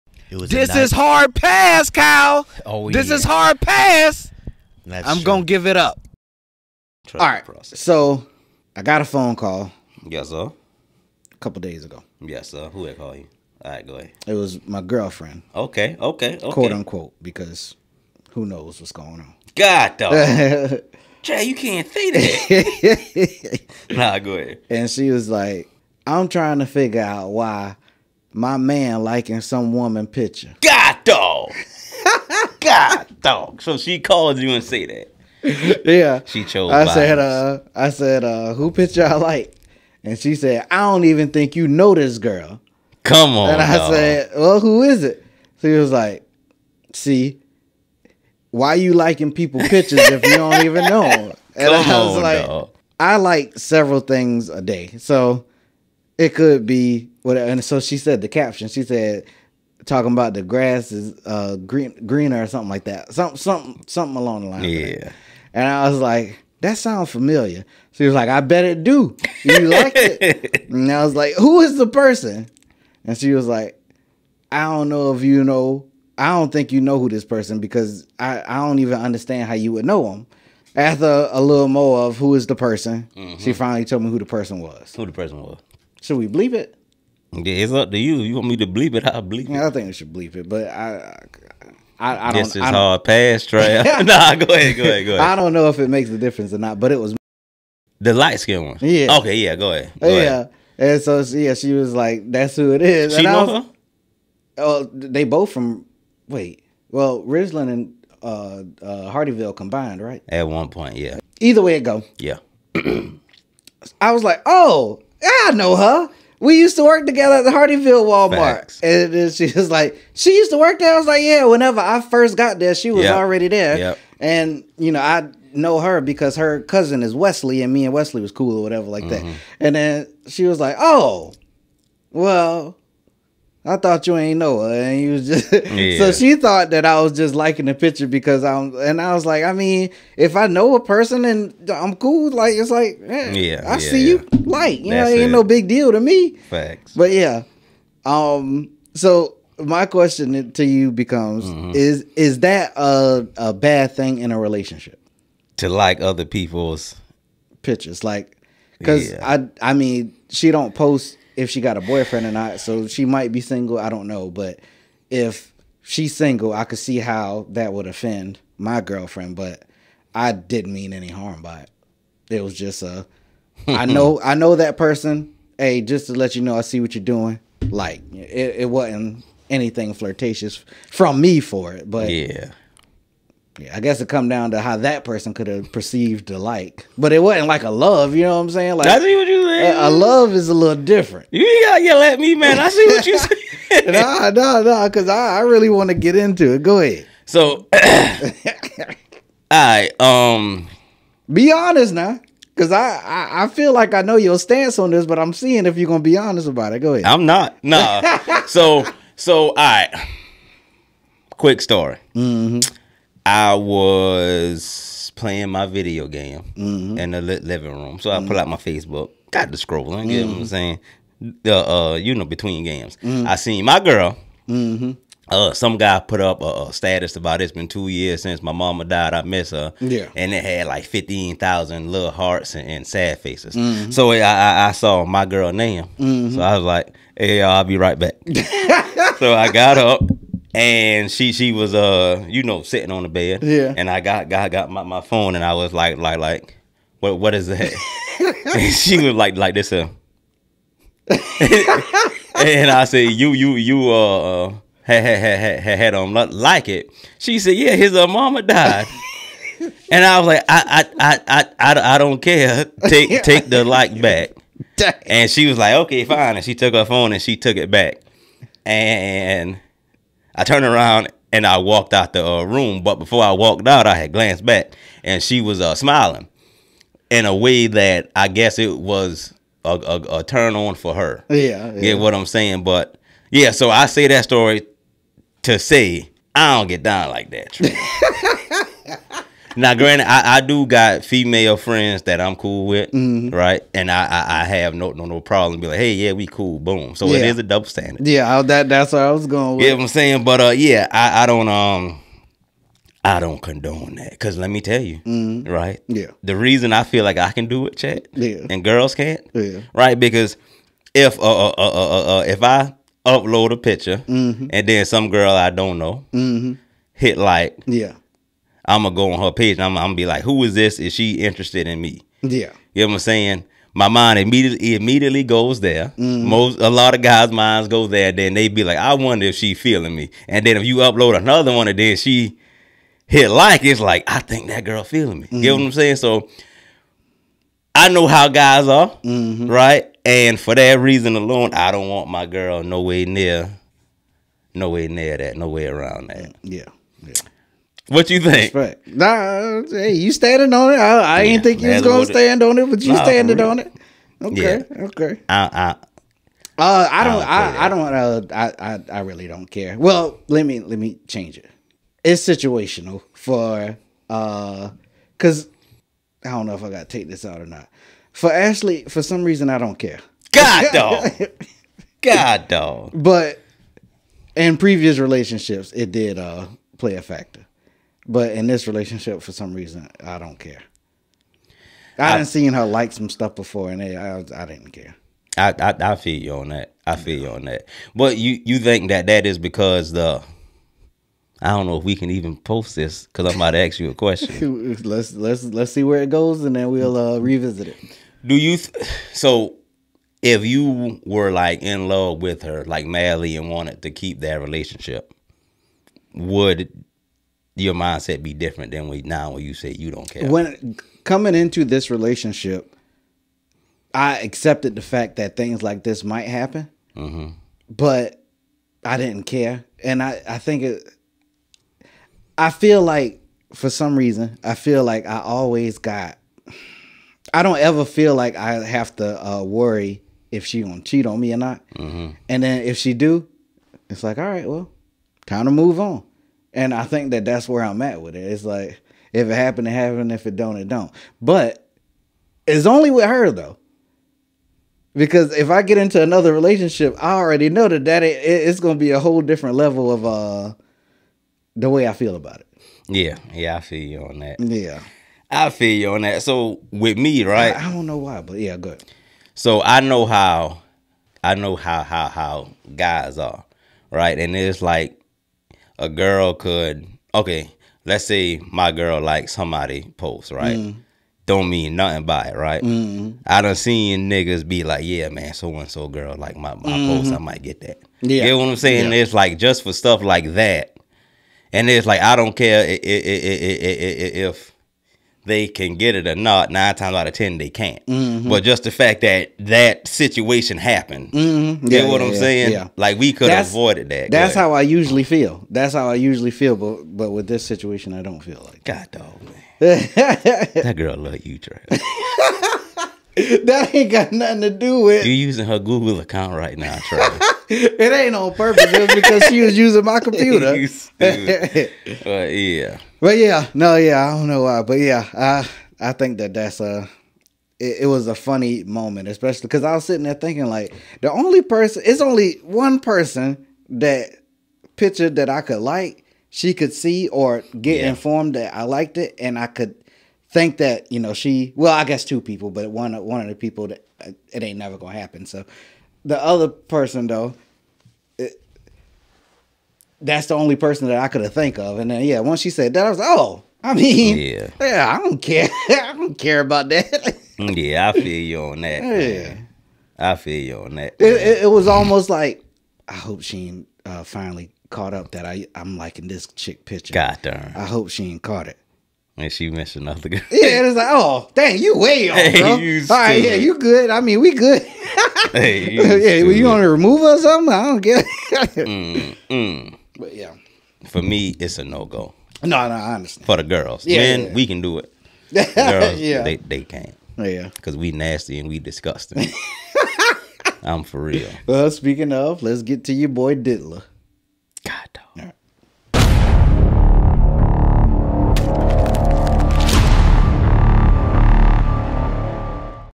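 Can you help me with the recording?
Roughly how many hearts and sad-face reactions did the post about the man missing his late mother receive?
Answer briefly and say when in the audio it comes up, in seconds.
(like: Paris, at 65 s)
15000, at 230 s.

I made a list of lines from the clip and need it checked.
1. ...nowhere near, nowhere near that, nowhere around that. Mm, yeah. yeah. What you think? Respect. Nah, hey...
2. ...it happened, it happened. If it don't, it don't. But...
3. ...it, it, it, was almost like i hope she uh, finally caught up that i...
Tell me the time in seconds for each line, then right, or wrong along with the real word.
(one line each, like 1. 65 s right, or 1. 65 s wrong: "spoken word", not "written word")
1. 342 s right
2. 439 s right
3. 550 s right.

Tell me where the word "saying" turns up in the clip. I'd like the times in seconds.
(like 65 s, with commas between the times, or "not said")
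188 s, 220 s, 282 s, 299 s, 322 s, 335 s, 478 s, 492 s.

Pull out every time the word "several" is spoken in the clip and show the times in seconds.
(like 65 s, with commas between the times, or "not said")
53 s.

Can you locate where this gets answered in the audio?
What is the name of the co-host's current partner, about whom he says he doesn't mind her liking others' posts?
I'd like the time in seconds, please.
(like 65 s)
368 s.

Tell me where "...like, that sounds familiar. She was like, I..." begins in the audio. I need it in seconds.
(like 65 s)
65 s.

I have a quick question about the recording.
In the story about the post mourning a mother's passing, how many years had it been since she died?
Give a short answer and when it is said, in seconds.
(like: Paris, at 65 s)
2, at 227 s.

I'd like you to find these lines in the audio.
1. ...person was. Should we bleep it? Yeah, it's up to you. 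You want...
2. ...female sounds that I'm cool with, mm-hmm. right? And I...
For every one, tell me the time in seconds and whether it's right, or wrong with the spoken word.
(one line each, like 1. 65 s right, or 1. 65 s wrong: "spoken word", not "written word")
1. 85 s right
2. 291 s wrong: "friends", not "sounds".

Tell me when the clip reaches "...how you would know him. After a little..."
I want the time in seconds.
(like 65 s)
79 s.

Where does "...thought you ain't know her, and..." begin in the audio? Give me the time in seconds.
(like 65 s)
133 s.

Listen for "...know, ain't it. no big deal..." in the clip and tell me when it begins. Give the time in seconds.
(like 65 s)
145 s.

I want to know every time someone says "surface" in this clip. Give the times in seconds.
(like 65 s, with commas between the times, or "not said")
not said.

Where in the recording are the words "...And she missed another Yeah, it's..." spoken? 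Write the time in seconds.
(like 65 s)
559 s.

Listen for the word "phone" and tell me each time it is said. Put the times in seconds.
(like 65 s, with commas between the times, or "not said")
9 s, 245 s, 266 s.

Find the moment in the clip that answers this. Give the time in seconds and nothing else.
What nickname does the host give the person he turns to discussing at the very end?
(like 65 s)
583 s.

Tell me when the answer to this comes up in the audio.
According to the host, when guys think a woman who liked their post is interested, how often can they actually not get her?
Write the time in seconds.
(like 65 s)
486 s.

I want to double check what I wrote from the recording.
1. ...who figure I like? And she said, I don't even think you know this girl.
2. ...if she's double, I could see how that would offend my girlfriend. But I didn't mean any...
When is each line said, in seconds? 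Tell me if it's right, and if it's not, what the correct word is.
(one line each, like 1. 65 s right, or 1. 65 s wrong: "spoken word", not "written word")
1. 38 s wrong: "picture", not "figure"
2. 165 s wrong: "single", not "double".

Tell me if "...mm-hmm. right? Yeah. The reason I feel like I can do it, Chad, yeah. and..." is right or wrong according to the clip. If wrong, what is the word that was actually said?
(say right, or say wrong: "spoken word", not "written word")
right.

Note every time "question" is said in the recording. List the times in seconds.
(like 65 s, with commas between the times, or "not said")
149 s, 393 s.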